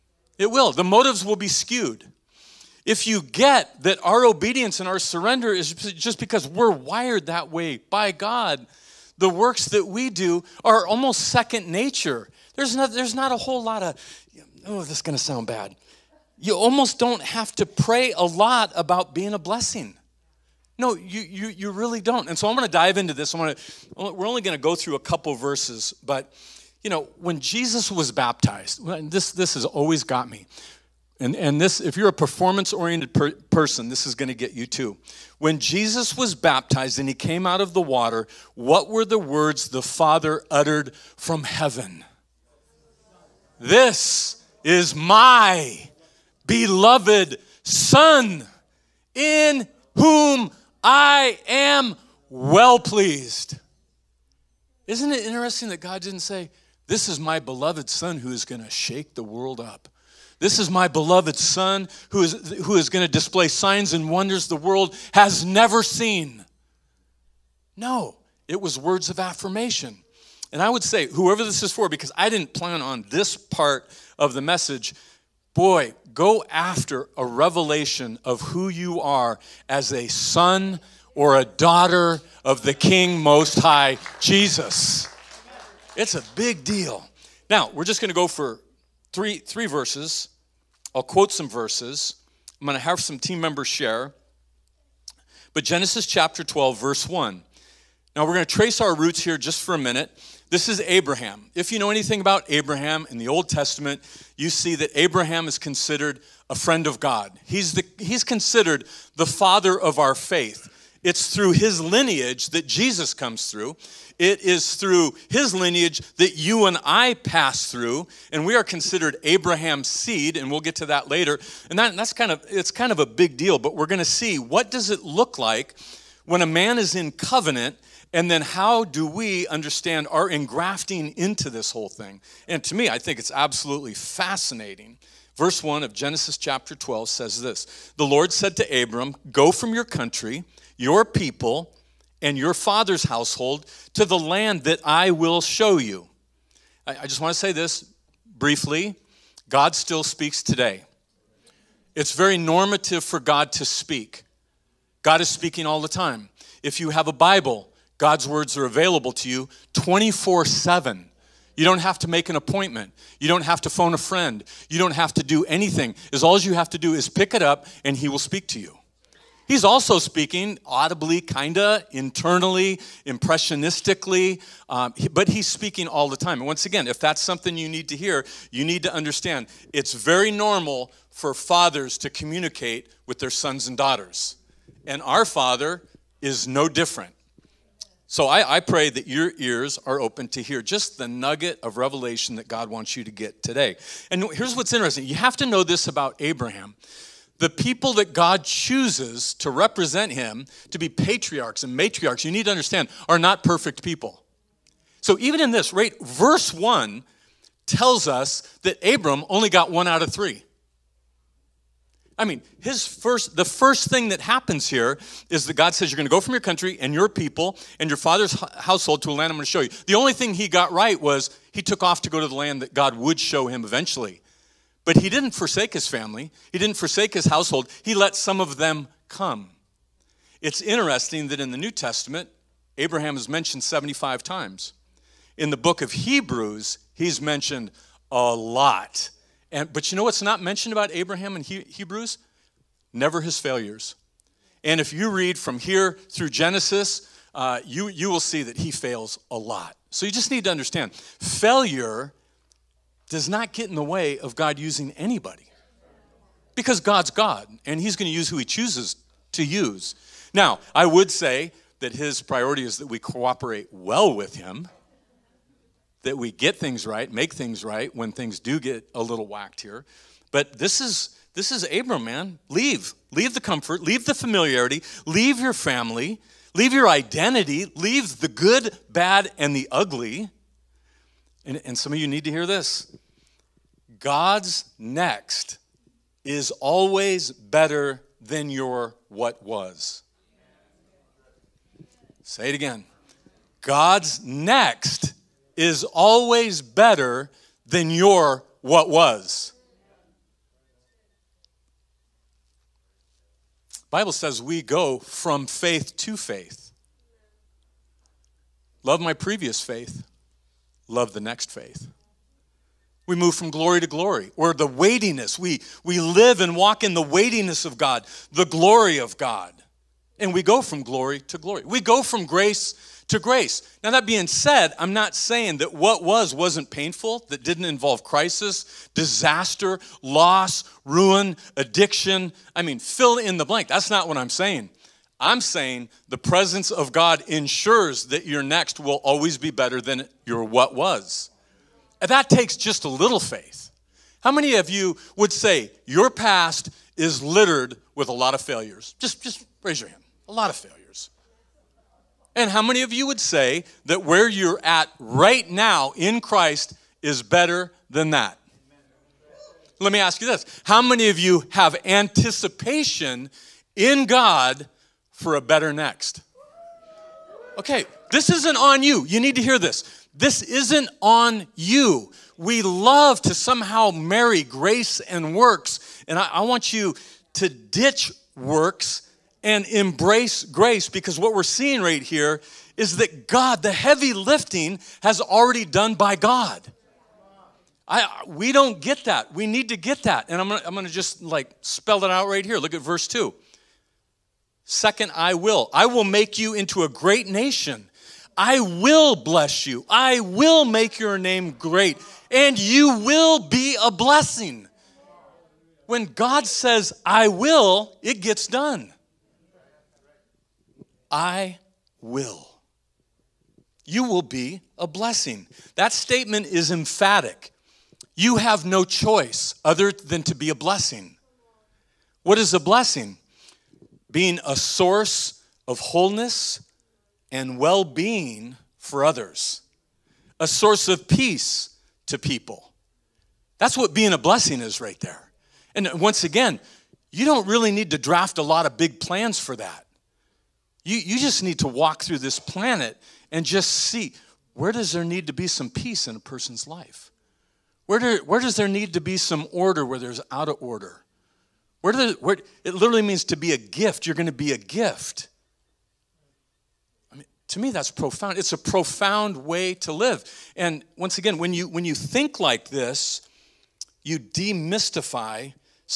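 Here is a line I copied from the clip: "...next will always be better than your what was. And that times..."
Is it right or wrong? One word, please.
wrong.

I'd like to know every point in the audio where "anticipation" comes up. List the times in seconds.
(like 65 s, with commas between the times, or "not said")
361 s.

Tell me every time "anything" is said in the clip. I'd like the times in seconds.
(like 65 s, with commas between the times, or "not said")
101 s, 165 s.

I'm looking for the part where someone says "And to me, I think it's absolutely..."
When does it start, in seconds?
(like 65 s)
132 s.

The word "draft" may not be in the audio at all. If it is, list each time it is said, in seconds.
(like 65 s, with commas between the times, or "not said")
437 s.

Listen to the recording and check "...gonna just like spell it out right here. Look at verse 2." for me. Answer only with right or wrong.
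right.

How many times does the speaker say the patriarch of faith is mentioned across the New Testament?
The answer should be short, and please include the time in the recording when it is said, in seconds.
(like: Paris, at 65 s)
75, at 233 s.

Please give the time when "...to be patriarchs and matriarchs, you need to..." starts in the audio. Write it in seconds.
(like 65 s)
200 s.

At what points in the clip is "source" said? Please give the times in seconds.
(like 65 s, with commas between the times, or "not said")
424 s, 430 s.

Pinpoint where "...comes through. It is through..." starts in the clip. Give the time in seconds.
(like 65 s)
113 s.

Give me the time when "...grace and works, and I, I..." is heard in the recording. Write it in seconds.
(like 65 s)
374 s.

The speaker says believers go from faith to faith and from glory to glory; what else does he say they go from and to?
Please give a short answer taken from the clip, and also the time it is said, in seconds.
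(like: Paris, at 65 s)
Grace to grace, at 322 s.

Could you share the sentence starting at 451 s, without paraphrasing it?
Where, the, where, it literally means to be a gift.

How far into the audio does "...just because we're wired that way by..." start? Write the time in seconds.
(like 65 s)
5 s.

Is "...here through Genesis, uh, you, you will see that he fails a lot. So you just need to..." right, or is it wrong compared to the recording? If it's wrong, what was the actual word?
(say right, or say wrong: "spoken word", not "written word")
right.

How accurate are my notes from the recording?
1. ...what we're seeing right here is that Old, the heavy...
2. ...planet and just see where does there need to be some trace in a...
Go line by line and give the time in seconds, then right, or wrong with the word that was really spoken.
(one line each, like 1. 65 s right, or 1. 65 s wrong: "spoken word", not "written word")
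1. 381 s wrong: "God", not "Old"
2. 442 s wrong: "peace", not "trace".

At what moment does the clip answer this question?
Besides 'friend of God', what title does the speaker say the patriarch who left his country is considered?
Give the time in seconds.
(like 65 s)
109 s.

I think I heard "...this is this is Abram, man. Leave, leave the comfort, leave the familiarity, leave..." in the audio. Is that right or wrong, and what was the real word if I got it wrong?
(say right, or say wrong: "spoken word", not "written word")
right.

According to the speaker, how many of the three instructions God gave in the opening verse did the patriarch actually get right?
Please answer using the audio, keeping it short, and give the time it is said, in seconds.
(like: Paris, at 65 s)
1 out of 3, at 209 s.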